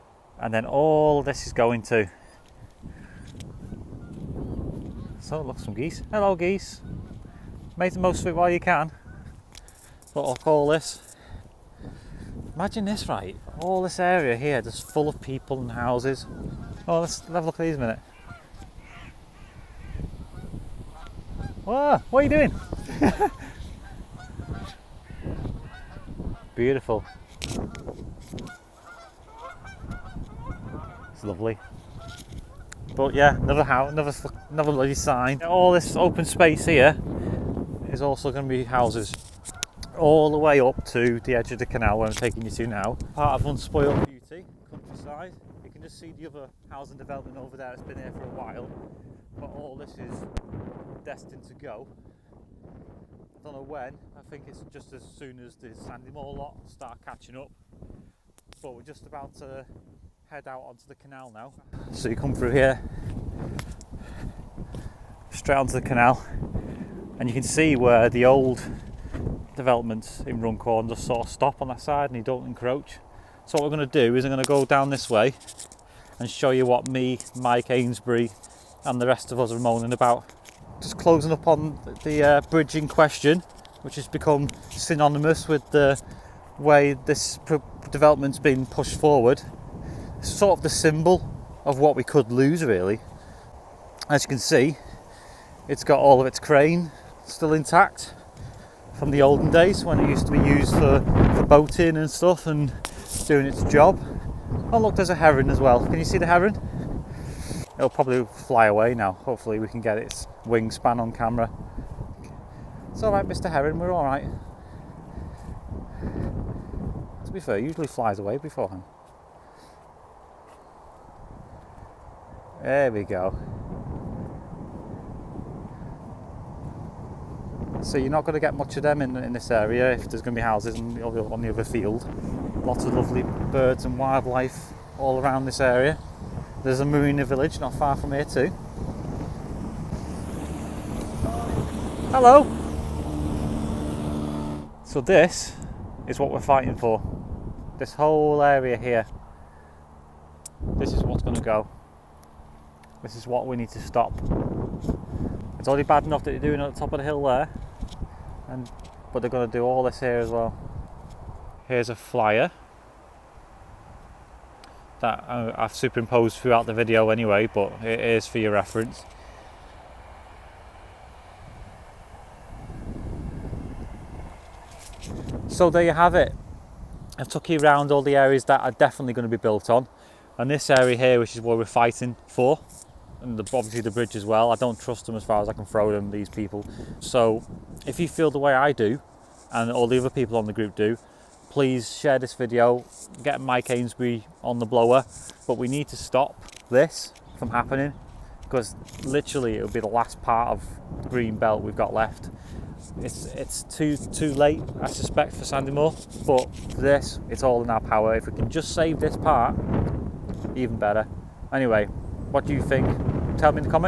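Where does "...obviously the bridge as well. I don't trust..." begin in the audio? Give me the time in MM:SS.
03:03.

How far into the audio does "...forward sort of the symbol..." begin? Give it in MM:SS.
01:28.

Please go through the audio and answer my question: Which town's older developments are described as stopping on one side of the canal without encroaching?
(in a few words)
Runcorn.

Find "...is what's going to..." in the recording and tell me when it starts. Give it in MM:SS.
02:30.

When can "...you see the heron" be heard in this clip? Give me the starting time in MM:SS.
01:45.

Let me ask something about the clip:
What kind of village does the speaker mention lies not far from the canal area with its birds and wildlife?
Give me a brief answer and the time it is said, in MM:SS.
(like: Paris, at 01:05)
Marina village, at 02:16.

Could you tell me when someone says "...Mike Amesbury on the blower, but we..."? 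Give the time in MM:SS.
03:13.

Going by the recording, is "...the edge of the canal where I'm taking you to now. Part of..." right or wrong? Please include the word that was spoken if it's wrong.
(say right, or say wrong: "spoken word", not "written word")
right.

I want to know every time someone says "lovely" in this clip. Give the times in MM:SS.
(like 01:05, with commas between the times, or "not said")
00:31, 02:12.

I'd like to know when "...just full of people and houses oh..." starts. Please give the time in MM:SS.
00:14.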